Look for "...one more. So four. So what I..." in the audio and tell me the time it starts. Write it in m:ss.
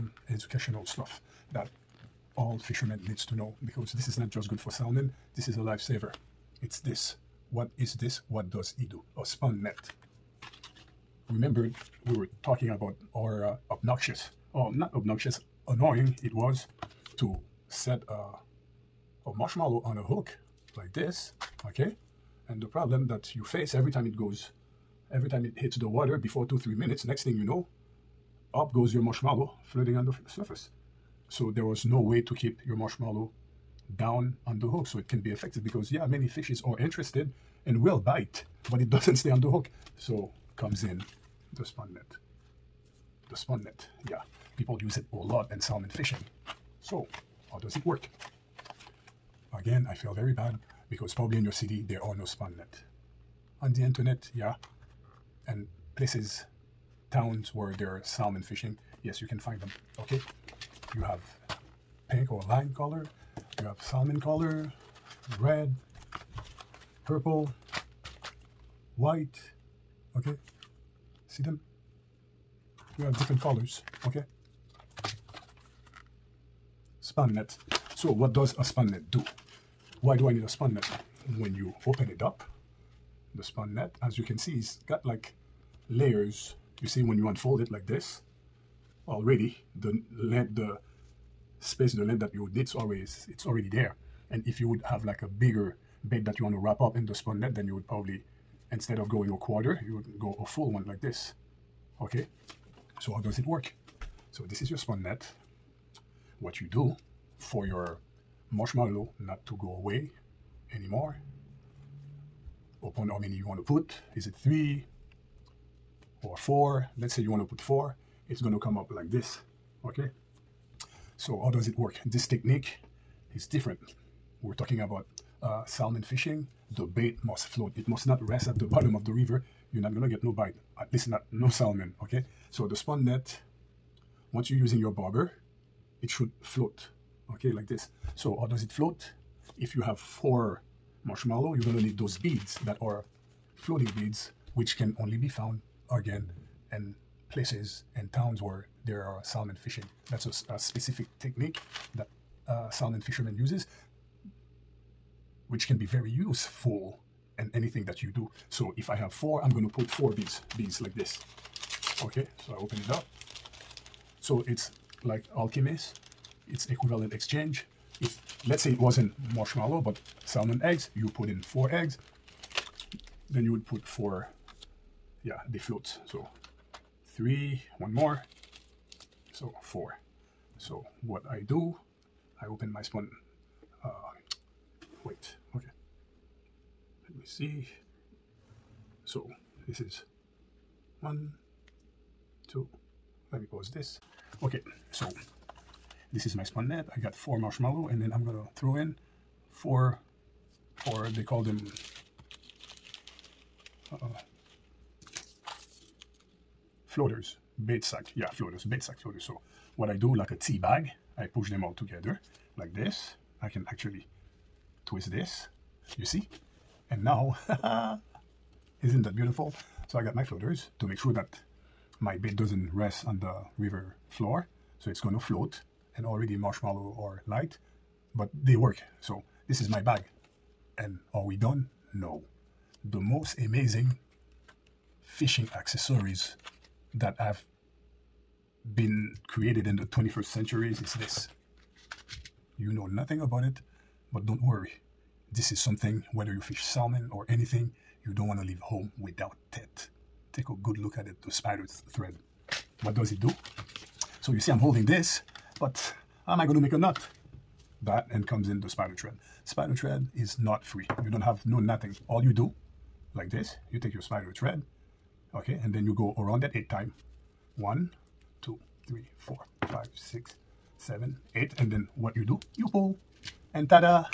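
2:57.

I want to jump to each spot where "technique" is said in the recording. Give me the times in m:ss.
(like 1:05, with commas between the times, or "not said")
2:02, 2:31.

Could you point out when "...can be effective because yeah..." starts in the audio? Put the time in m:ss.
0:35.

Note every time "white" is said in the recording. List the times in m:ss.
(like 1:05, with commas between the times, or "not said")
1:08.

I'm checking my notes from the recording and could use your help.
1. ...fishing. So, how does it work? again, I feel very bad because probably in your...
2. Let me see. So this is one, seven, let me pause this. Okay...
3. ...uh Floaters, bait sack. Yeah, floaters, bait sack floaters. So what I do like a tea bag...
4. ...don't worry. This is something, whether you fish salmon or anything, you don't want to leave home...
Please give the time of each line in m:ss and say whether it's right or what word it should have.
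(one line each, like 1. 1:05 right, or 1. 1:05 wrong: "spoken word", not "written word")
1. 0:45 right
2. 3:07 wrong: "two", not "seven"
3. 3:23 right
4. 4:04 right.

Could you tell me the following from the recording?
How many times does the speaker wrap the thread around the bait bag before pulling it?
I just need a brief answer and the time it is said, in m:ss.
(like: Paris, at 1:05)
8, at 4:26.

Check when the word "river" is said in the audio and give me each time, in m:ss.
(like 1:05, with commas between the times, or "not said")
2:09, 3:43.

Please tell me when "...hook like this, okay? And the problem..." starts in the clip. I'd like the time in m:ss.
0:20.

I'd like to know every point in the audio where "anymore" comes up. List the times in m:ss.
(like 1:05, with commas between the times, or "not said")
1:50.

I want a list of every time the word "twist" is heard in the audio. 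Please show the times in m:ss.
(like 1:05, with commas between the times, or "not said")
3:34.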